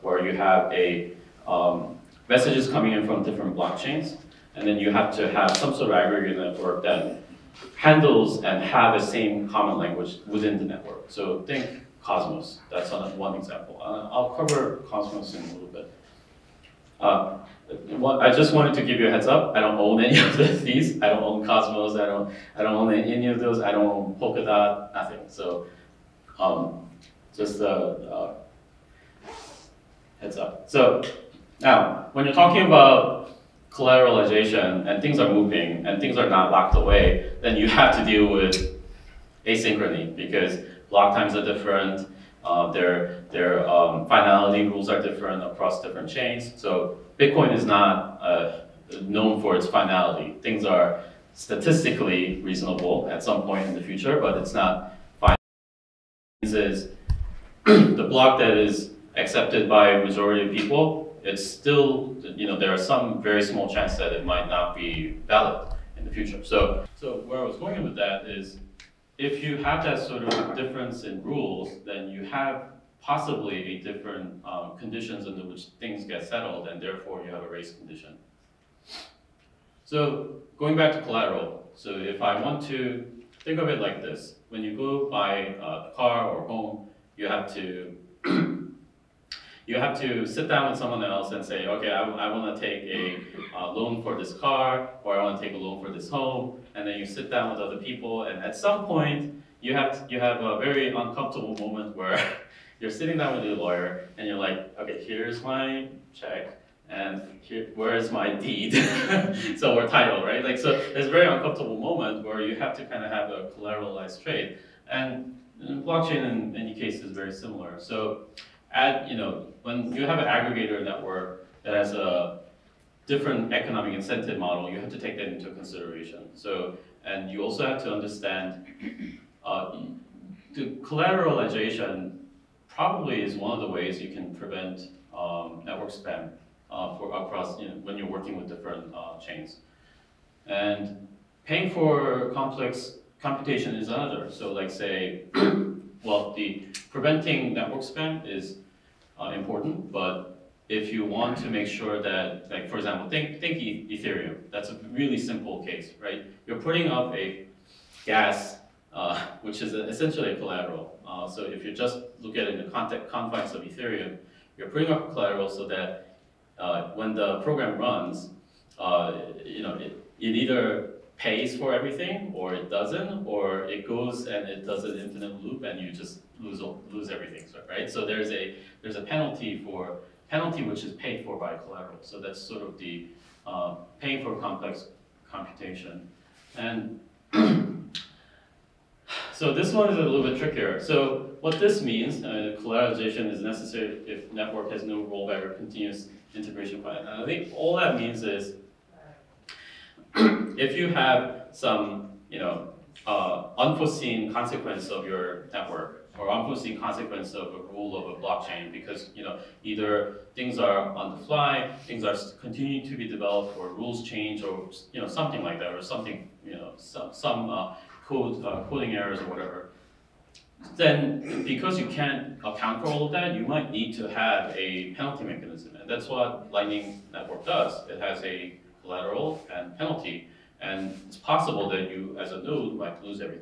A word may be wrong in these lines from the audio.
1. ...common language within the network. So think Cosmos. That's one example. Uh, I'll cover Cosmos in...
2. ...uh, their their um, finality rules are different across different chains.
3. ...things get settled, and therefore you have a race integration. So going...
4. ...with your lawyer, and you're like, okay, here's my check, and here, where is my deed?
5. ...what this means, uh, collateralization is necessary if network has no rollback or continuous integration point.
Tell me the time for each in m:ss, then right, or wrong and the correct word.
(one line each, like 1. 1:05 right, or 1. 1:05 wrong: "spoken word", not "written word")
1. 0:09 right
2. 0:42 right
3. 1:15 wrong: "condition", not "integration"
4. 1:43 right
5. 3:11 right.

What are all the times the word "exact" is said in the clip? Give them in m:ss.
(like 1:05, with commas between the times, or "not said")
not said.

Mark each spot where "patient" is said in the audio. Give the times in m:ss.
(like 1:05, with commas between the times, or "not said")
not said.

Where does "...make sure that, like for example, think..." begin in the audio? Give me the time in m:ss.
2:31.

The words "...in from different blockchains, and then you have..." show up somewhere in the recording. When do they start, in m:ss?
0:02.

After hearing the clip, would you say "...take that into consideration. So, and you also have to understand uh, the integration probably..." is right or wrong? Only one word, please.
wrong.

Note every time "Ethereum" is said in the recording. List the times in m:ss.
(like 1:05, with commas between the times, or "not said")
2:33, 2:43.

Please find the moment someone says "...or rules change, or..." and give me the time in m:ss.
3:33.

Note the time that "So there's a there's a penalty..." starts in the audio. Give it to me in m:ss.
2:57.